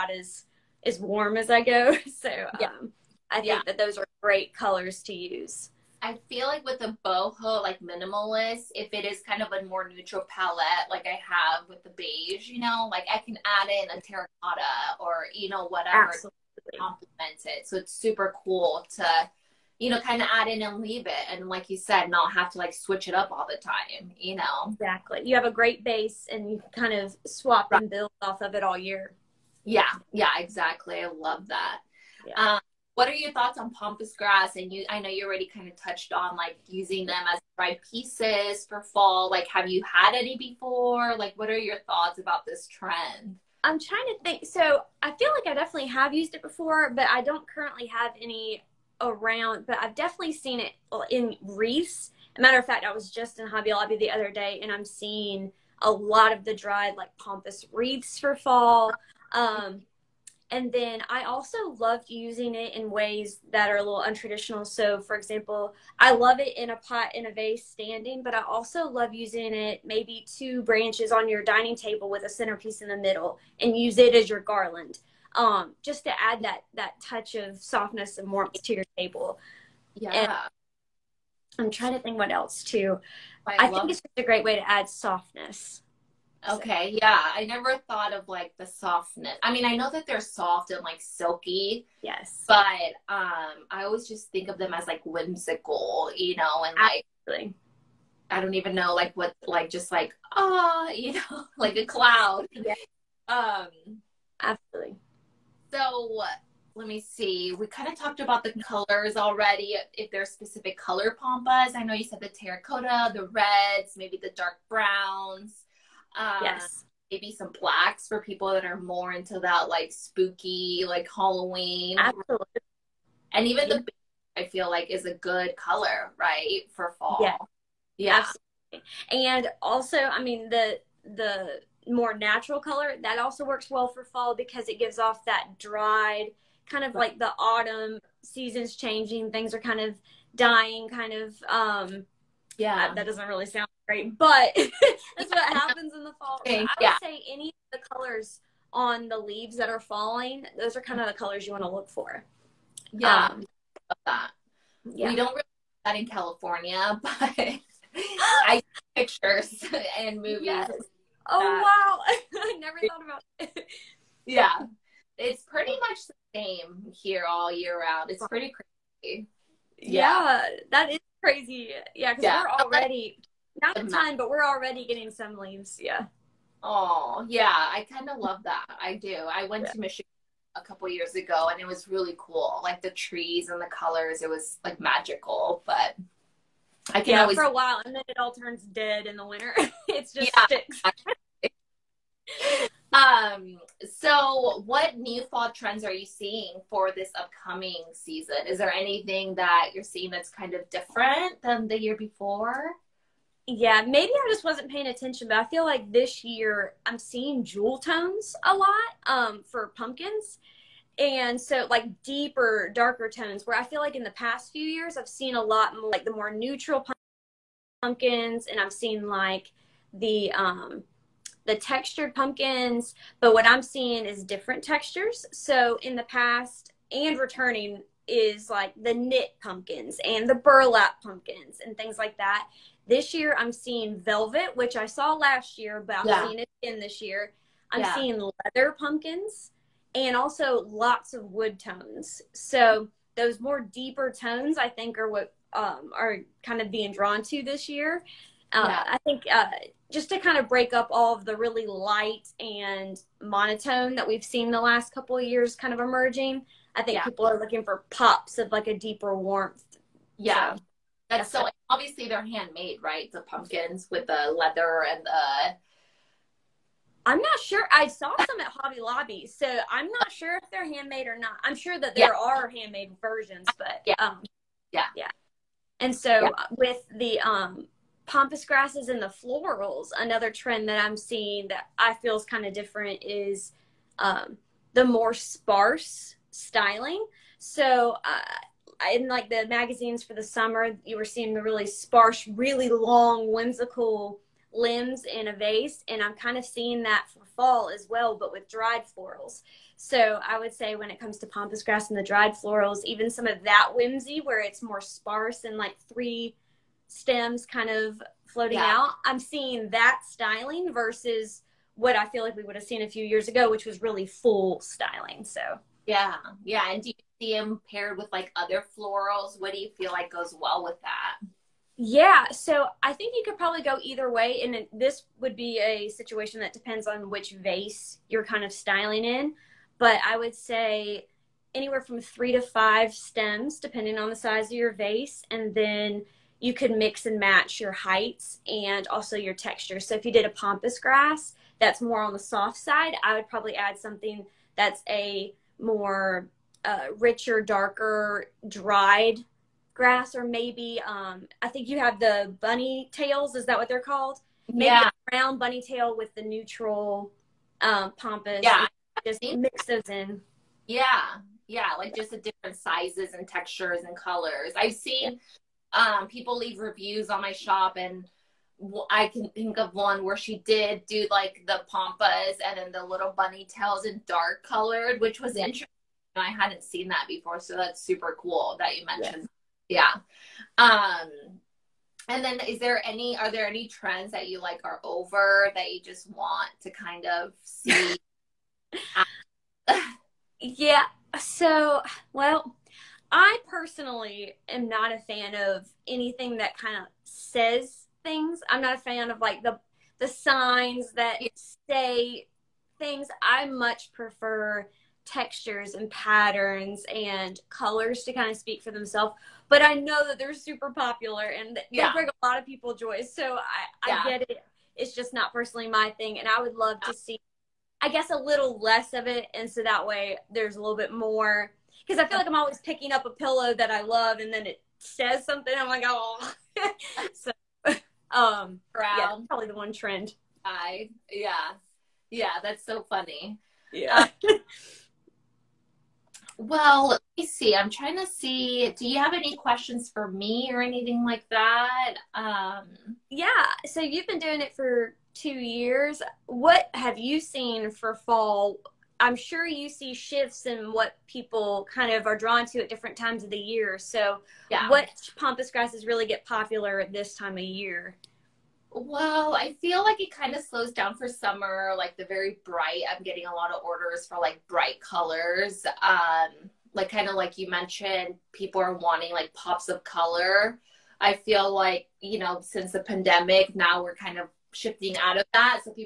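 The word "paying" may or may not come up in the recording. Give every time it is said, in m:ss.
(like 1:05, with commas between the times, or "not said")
3:24.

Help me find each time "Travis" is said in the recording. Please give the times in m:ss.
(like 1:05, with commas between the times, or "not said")
not said.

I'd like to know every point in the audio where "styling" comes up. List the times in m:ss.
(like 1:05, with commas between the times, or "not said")
4:46, 5:10, 5:14, 5:28.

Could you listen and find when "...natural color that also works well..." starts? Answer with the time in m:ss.
2:12.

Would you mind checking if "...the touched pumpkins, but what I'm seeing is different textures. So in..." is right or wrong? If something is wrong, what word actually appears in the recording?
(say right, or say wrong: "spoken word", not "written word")
wrong: "textured", not "touched".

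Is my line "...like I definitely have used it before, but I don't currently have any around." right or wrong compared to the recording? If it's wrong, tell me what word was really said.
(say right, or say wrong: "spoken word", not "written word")
right.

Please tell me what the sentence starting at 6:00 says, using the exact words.
Yeah, yeah, like just the different sizes and textures and colors.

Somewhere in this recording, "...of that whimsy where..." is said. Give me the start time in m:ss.
5:03.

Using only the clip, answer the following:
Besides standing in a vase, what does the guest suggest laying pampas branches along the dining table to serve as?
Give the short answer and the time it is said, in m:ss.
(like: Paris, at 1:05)
garland, at 1:14.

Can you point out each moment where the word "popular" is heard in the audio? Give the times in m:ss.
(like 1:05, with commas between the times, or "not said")
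6:50, 7:36.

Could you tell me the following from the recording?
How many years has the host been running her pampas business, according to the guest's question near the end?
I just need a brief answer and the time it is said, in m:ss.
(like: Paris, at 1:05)
2, at 7:25.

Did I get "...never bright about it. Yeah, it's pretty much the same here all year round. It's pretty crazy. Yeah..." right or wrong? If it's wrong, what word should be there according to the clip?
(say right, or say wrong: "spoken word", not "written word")
wrong: "thought", not "bright".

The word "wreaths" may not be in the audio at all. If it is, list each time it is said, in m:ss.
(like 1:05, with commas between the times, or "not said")
0:51, 0:57.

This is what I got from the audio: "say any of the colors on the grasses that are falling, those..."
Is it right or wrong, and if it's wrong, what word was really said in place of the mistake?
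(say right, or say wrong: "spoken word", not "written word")
wrong: "leaves", not "grasses".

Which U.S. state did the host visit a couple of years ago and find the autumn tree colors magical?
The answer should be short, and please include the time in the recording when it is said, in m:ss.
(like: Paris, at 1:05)
Michigan, at 2:59.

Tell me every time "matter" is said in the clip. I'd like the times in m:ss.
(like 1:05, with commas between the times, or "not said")
0:52.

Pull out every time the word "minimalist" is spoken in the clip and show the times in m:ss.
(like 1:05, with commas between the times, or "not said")
0:07.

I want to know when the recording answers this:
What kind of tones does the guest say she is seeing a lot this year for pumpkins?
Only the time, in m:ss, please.
3:27.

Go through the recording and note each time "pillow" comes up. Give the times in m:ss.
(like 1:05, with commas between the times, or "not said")
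7:03.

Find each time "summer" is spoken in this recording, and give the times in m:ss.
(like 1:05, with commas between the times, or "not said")
4:50, 7:41.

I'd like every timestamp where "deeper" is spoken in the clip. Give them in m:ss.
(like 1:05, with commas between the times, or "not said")
3:32, 4:03, 4:18.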